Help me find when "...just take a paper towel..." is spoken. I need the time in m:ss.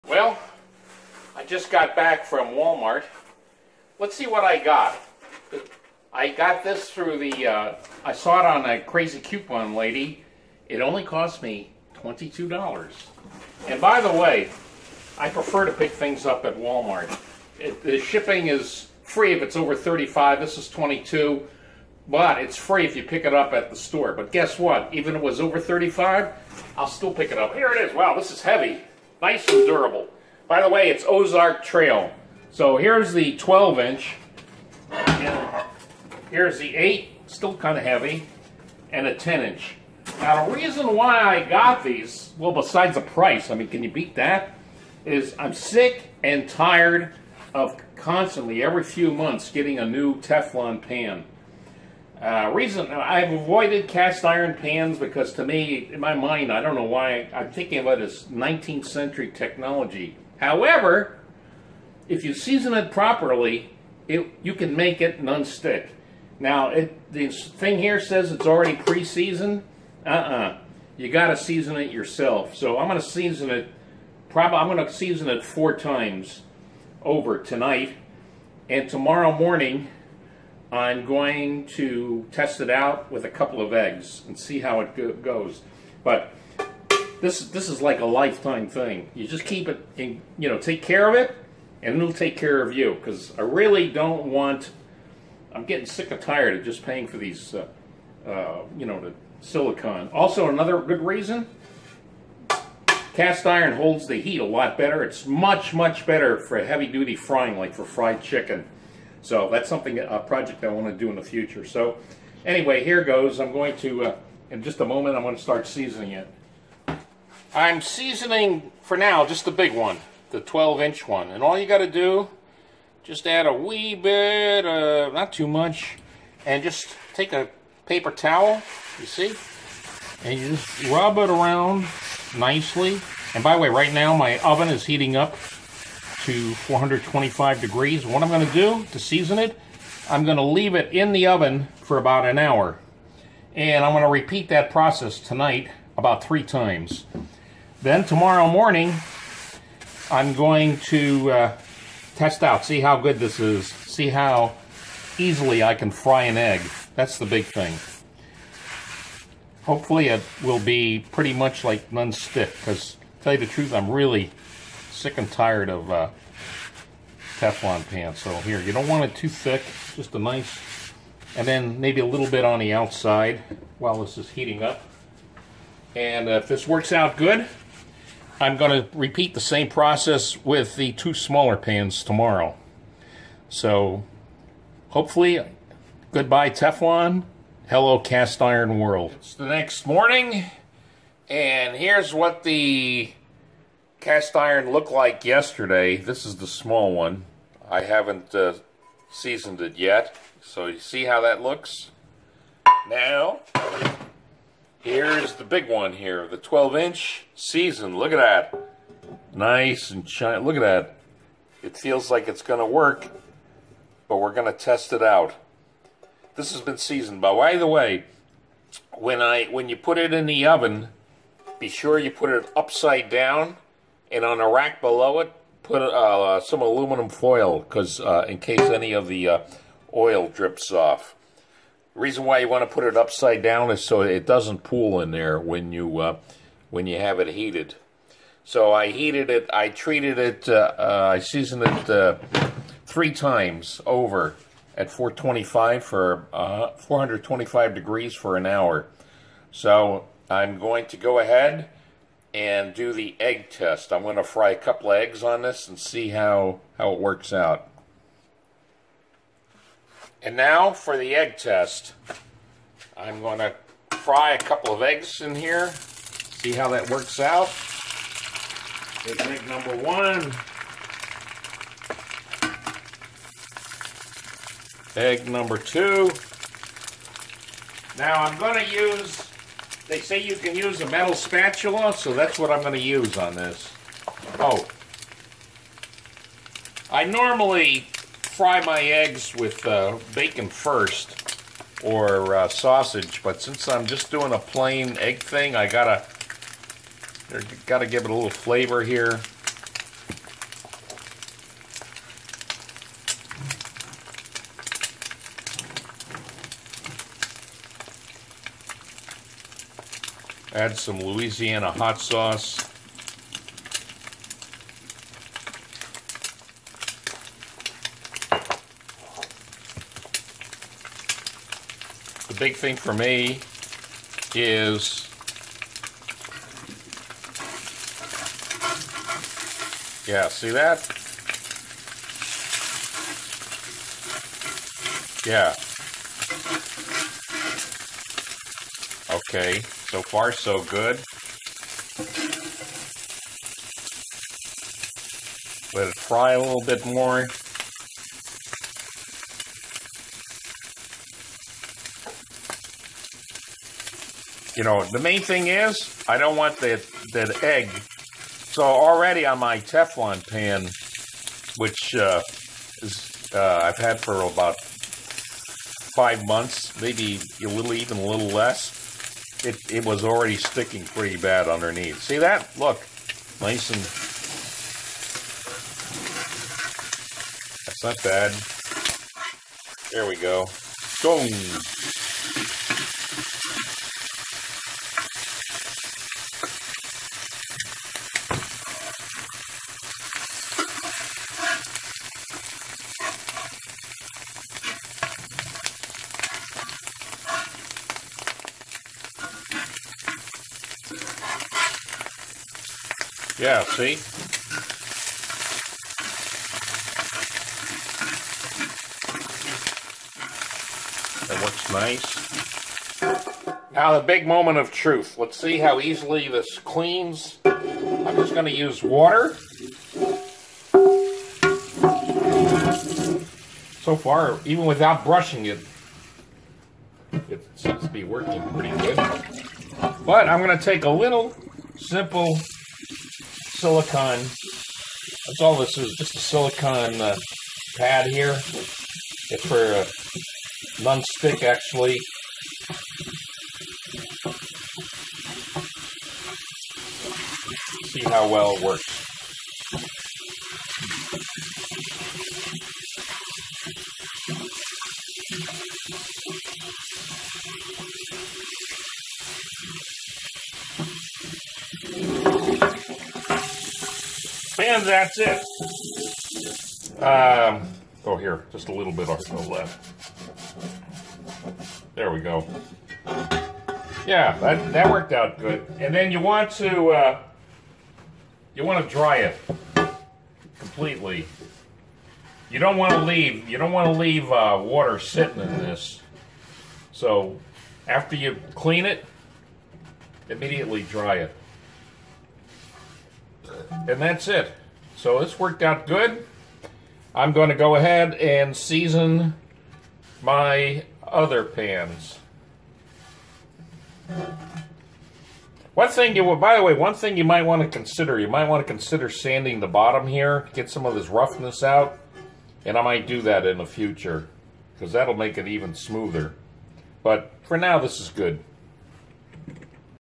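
2:06.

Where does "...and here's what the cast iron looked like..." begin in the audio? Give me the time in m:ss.
3:11.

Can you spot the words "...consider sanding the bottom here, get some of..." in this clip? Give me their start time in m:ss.
8:28.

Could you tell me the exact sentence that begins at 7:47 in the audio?
Um, oh, here, just a little bit of so left.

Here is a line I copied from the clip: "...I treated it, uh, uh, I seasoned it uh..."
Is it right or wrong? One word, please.
right.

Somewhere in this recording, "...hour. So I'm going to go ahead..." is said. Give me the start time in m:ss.
4:08.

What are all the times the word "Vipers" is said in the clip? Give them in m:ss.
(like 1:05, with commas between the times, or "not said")
not said.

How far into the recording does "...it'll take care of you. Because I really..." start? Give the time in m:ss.
1:31.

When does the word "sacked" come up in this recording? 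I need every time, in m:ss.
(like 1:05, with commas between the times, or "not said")
not said.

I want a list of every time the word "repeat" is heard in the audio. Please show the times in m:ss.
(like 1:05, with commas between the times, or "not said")
2:24, 2:58.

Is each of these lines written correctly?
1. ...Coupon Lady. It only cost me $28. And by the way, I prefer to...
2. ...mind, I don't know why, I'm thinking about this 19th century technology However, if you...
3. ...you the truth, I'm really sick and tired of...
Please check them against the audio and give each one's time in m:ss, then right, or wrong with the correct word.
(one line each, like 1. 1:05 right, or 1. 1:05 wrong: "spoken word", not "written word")
1. 0:09 wrong: "22", not "28"
2. 0:56 right
3. 2:43 right.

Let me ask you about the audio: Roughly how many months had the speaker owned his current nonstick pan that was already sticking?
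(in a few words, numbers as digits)
5 months.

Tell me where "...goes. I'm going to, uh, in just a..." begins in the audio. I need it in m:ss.
1:53.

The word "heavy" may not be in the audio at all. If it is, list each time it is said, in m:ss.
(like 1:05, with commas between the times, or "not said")
0:28, 0:37, 1:46.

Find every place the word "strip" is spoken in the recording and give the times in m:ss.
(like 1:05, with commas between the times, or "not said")
not said.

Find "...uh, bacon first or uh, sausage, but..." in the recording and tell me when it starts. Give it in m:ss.
4:49.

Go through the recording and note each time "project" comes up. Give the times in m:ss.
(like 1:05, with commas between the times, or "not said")
1:50.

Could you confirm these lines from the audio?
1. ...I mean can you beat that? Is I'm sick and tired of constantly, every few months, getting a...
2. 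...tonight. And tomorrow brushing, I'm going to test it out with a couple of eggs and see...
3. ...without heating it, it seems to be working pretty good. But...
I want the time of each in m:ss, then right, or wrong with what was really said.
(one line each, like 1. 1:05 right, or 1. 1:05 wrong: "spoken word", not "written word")
1. 0:43 right
2. 1:17 wrong: "morning", not "brushing"
3. 7:04 wrong: "brushing", not "heating".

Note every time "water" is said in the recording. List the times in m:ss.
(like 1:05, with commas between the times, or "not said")
6:58, 8:04.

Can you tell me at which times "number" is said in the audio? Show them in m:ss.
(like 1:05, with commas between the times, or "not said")
4:29, 4:35.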